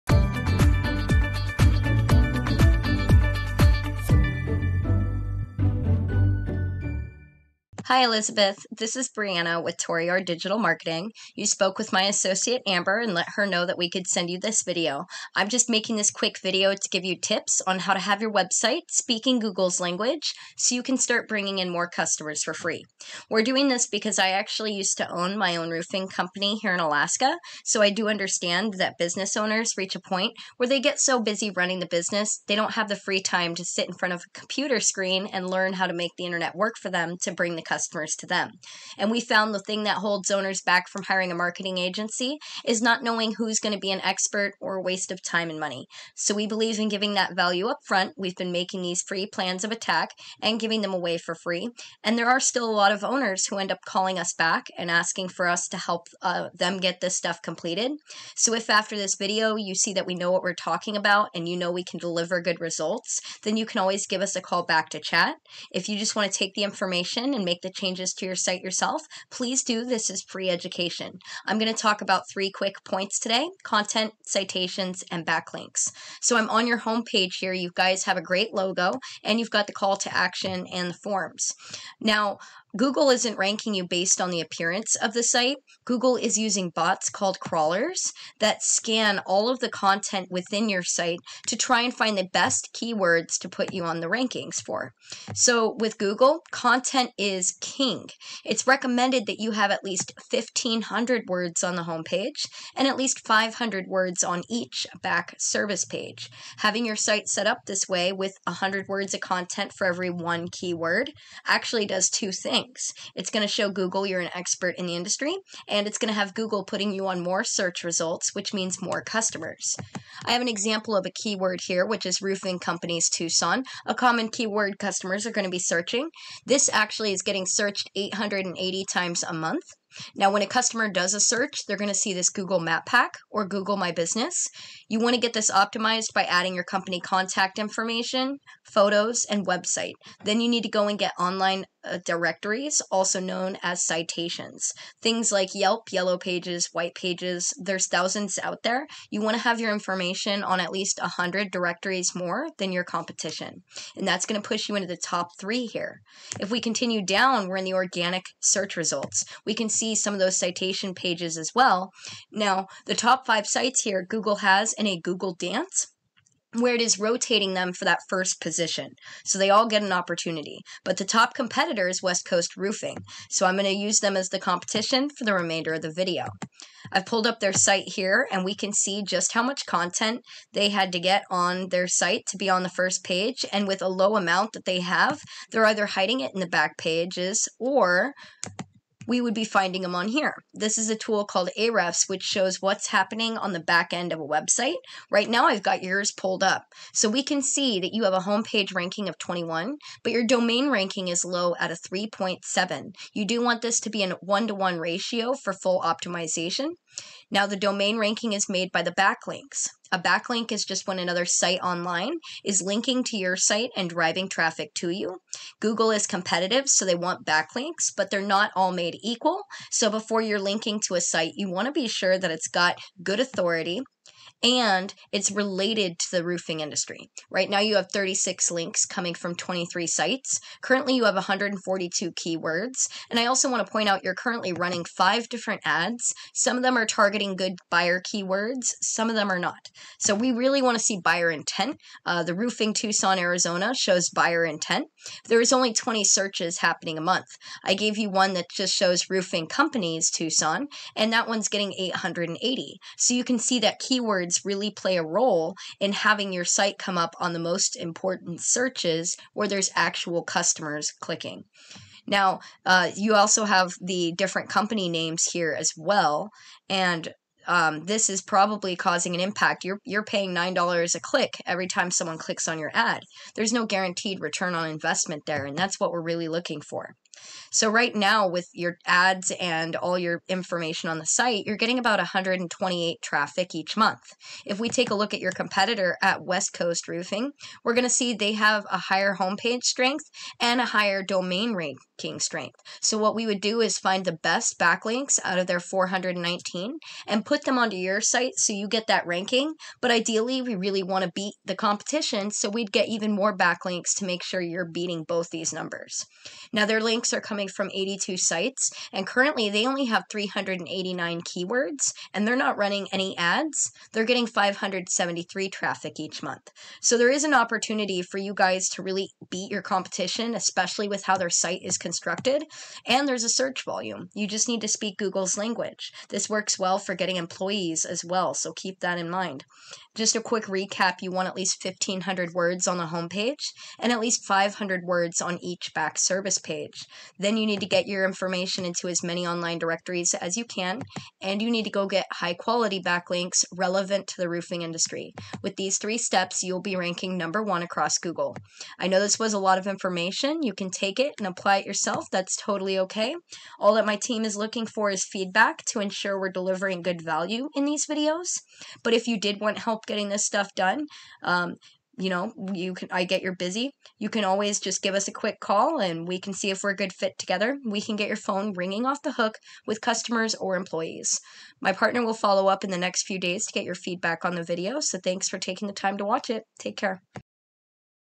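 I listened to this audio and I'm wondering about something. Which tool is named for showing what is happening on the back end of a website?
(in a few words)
Ahrefs.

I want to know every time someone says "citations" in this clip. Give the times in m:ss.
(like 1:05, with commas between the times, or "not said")
1:14, 2:23, 2:40.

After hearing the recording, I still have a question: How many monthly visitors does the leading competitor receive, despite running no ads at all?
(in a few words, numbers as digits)
573.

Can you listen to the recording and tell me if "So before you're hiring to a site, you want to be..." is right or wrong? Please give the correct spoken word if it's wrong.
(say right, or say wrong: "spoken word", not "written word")
wrong: "linking", not "hiring".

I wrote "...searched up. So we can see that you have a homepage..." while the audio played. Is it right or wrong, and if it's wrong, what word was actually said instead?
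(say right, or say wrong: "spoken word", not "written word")
wrong: "pulled", not "searched".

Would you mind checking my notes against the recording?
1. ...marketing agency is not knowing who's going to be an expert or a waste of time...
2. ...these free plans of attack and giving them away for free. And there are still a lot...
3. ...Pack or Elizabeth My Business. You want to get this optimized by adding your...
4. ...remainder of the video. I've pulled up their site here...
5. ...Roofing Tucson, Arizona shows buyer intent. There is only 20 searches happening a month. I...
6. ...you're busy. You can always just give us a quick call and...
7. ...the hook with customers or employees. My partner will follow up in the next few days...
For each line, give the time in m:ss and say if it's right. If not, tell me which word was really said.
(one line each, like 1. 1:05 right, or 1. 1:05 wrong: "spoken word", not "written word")
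1. 0:41 right
2. 0:48 right
3. 2:12 wrong: "Google", not "Elizabeth"
4. 2:55 right
5. 4:02 right
6. 6:03 right
7. 6:09 right.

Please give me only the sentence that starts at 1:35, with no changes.
So with Google, content is king.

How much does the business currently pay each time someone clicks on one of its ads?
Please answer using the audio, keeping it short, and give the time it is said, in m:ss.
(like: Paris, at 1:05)
$9, at 4:30.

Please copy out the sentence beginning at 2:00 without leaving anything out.
I have an example of a keyword here, which is roofing companies Tucson, a common keyword customers are going to be searching.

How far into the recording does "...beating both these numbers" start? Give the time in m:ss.
5:04.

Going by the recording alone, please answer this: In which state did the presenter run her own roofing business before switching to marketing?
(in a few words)
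Alaska.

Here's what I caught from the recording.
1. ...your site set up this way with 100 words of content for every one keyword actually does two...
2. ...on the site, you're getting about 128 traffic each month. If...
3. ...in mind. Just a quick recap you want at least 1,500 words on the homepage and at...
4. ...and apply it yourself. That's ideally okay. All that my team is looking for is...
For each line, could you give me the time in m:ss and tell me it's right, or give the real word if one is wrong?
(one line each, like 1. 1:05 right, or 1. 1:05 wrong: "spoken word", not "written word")
1. 1:46 right
2. 4:40 right
3. 5:28 right
4. 5:51 wrong: "totally", not "ideally".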